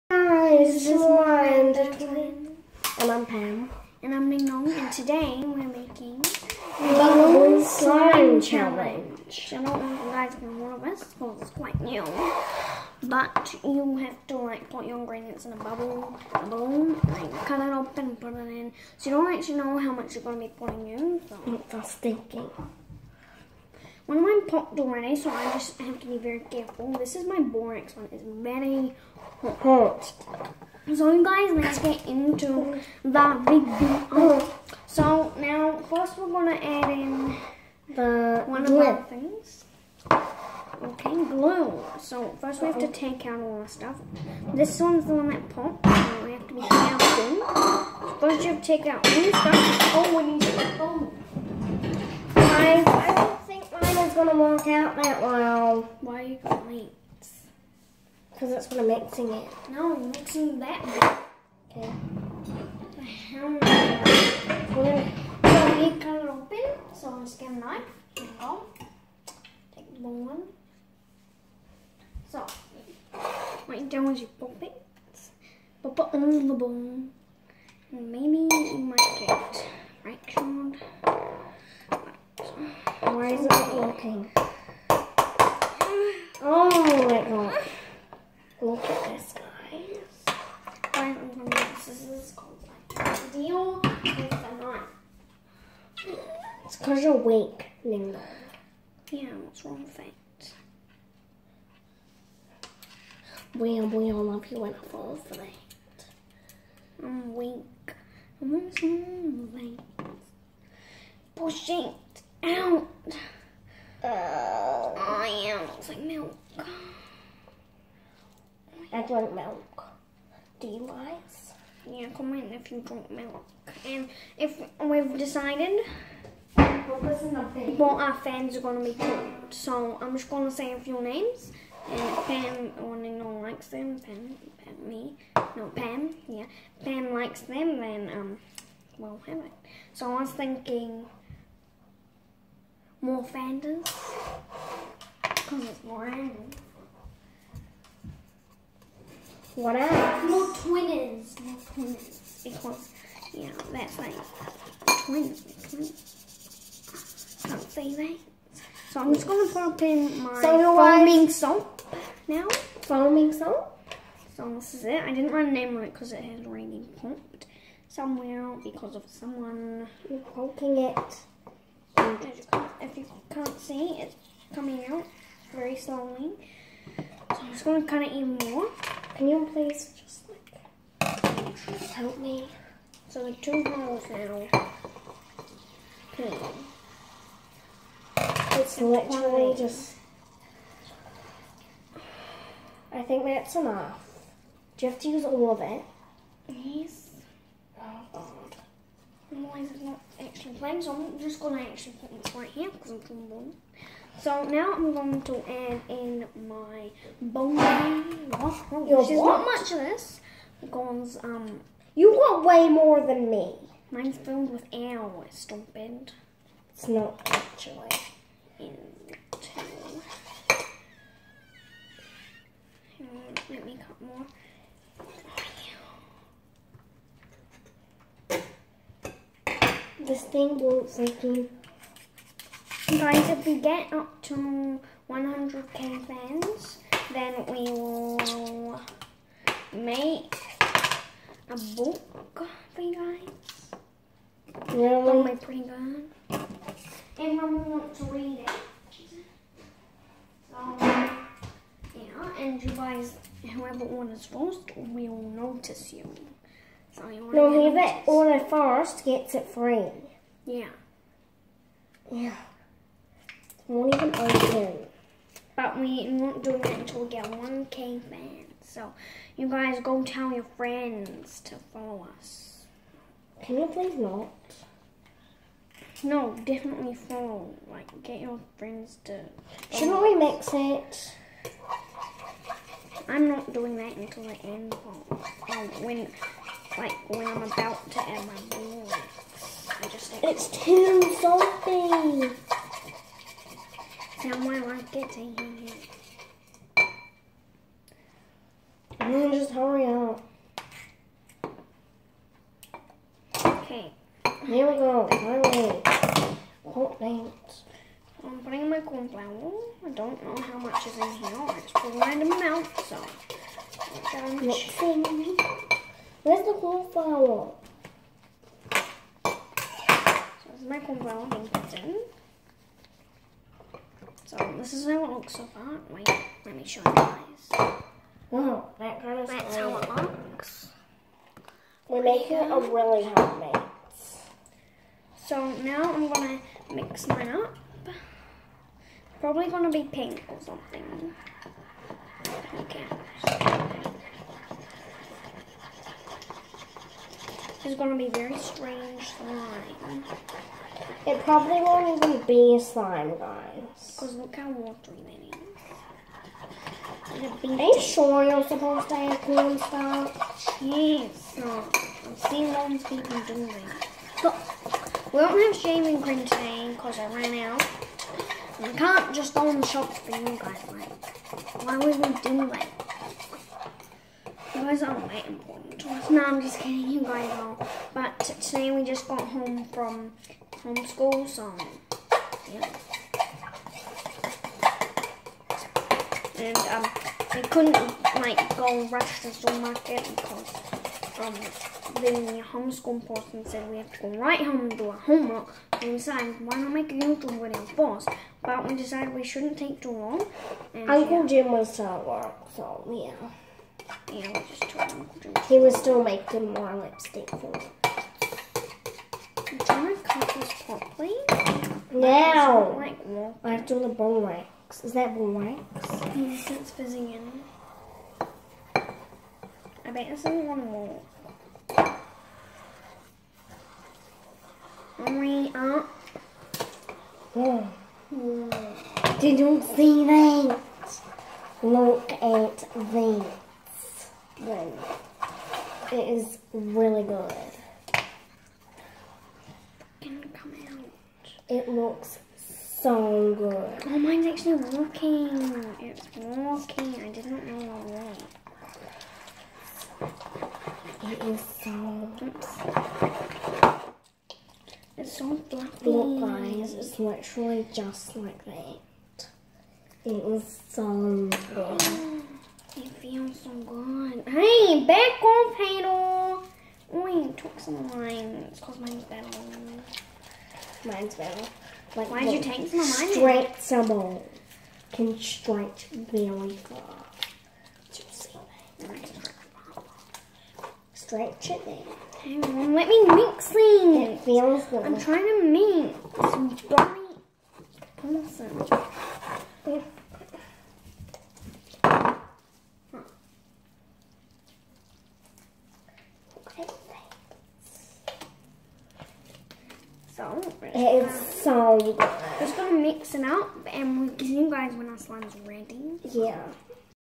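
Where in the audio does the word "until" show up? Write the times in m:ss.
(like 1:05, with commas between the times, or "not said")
4:26, 4:43.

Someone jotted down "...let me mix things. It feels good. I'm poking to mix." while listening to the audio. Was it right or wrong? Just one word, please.
wrong.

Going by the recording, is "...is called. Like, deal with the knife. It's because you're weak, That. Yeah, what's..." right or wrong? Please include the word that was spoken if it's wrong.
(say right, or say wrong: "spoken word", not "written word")
wrong: "Linda", not "That".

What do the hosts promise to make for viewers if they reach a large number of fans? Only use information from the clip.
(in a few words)
a book.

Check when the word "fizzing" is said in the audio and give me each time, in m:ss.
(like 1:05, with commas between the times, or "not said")
6:56.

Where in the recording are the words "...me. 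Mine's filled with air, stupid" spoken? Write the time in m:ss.
3:33.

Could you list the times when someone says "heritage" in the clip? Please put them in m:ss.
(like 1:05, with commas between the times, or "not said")
not said.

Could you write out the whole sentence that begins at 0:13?
But you have to like put your ingredients in a bubble, a balloon, like cut it open and put it in.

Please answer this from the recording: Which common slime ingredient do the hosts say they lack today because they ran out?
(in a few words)
shaving cream.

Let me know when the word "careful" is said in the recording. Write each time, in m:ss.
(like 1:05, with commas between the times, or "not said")
0:26, 0:46.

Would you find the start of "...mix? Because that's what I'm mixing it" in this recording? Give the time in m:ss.
0:56.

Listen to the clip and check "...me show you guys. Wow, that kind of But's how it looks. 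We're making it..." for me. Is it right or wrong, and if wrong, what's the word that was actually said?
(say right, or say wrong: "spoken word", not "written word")
wrong: "That", not "But".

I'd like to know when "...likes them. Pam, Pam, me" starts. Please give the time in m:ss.
2:13.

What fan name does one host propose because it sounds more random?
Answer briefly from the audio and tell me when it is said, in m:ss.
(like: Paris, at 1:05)
more fandom, at 2:23.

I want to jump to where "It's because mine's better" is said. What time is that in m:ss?
7:48.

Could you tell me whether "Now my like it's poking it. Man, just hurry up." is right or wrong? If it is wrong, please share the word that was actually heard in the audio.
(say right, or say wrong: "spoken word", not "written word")
wrong: "eating", not "poking".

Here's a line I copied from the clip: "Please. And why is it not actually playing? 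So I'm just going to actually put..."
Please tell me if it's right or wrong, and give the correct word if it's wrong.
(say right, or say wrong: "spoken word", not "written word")
right.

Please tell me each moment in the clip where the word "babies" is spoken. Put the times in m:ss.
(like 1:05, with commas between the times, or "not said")
not said.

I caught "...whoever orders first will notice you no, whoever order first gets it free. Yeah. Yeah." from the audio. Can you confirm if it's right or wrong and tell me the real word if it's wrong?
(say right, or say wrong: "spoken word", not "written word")
right.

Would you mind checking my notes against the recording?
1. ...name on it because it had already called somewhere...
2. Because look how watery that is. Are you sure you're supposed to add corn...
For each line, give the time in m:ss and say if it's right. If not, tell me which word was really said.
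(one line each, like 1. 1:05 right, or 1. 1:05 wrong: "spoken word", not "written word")
1. 2:45 wrong: "popped", not "called"
2. 5:53 right.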